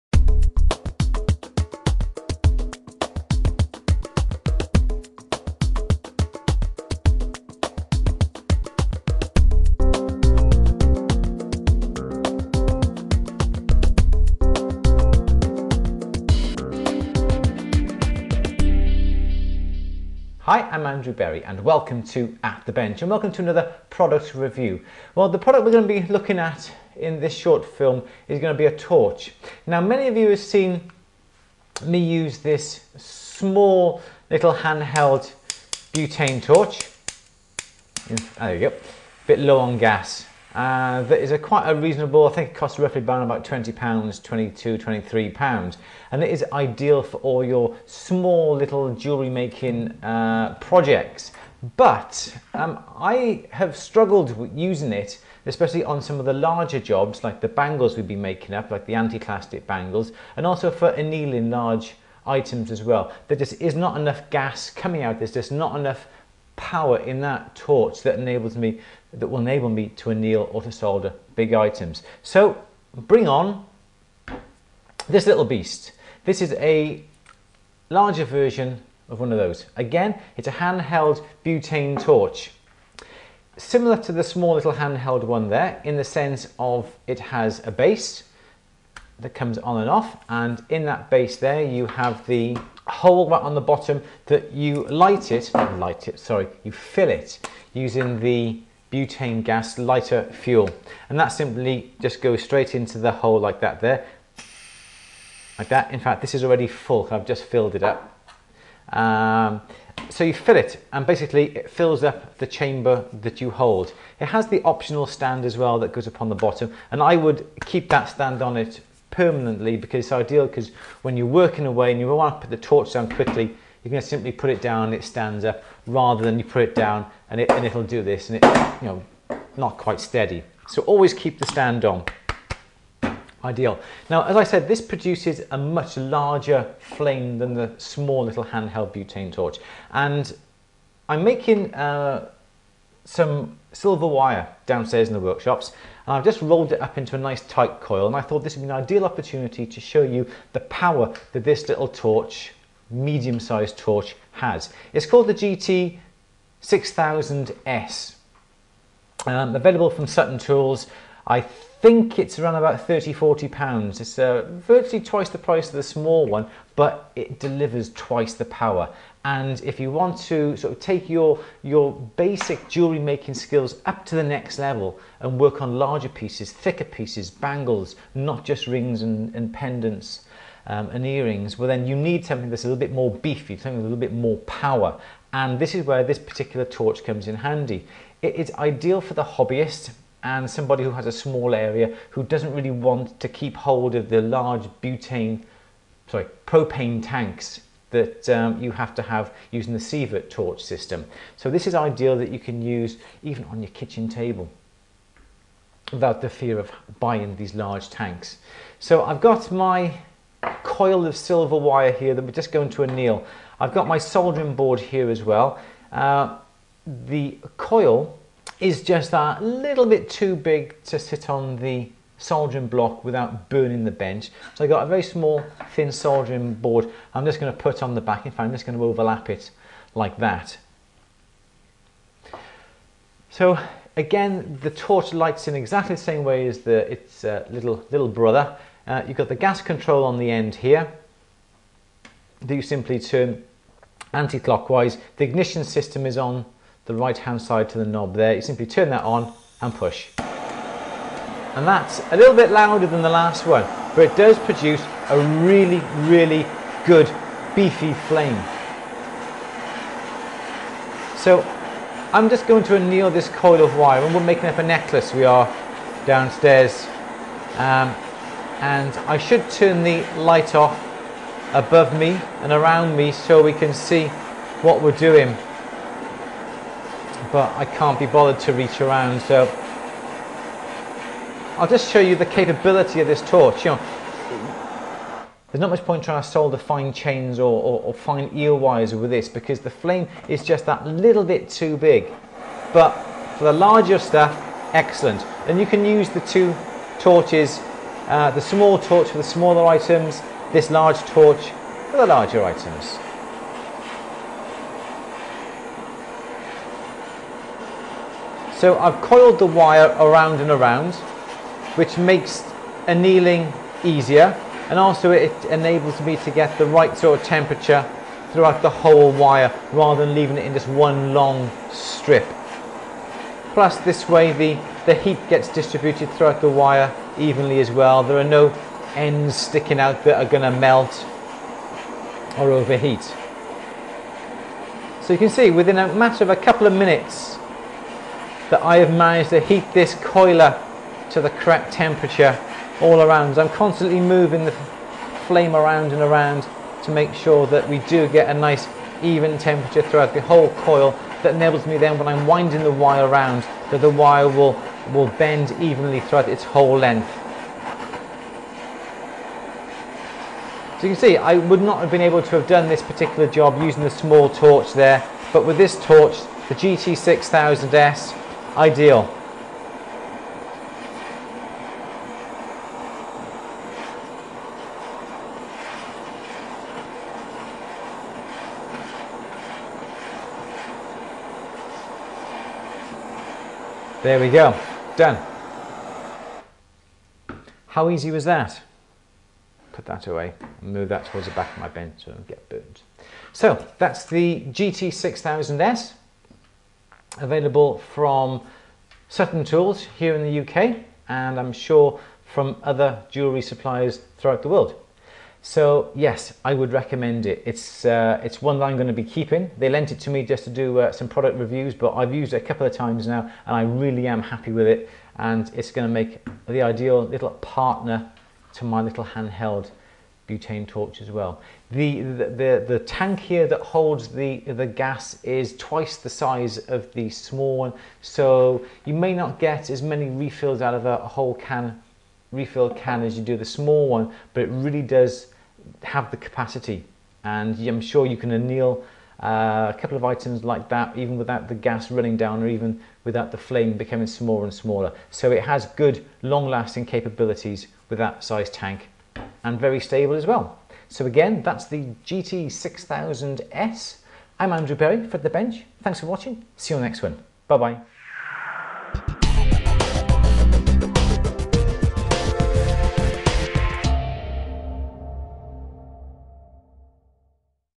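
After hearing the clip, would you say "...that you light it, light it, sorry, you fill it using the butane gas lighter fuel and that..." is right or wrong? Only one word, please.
right.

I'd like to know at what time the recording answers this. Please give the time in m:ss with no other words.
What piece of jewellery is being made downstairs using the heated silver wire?
4:24.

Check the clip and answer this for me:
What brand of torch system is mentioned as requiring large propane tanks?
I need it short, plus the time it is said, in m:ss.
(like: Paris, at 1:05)
Sievert, at 3:19.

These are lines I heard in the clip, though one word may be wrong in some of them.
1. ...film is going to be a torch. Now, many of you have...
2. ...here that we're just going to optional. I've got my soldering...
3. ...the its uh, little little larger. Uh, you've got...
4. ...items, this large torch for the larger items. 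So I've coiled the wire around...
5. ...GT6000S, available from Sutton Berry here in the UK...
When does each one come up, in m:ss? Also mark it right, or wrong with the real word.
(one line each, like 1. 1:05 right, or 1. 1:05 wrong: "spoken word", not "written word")
1. 0:27 right
2. 3:31 wrong: "anneal", not "optional"
3. 3:56 wrong: "brother", not "larger"
4. 4:59 right
5. 6:34 wrong: "Tools", not "Berry".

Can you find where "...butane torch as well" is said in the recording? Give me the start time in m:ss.
7:00.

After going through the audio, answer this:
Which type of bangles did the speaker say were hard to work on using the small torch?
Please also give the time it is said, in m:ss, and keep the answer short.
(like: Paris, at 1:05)
anti clastic bangles, at 0:58.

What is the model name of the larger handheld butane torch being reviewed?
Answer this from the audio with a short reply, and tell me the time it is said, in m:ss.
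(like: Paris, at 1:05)
GT 6000S, at 2:35.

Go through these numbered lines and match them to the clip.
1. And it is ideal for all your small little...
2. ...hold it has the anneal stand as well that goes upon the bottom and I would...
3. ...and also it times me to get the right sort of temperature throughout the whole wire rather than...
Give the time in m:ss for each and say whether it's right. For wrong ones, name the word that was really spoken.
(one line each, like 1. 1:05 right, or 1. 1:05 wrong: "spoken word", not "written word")
1. 0:46 right
2. 1:53 wrong: "optional", not "anneal"
3. 5:14 wrong: "enables", not "times".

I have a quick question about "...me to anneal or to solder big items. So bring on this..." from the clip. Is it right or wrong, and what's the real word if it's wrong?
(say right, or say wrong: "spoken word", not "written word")
right.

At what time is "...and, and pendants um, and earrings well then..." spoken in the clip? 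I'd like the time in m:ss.
2:59.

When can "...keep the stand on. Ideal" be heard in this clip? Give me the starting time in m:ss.
2:11.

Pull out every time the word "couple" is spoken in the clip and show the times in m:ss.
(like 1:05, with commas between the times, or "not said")
5:36, 6:52, 7:19.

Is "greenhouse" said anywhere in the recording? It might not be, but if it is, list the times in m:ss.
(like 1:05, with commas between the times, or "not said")
not said.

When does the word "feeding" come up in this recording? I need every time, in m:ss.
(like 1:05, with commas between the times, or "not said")
not said.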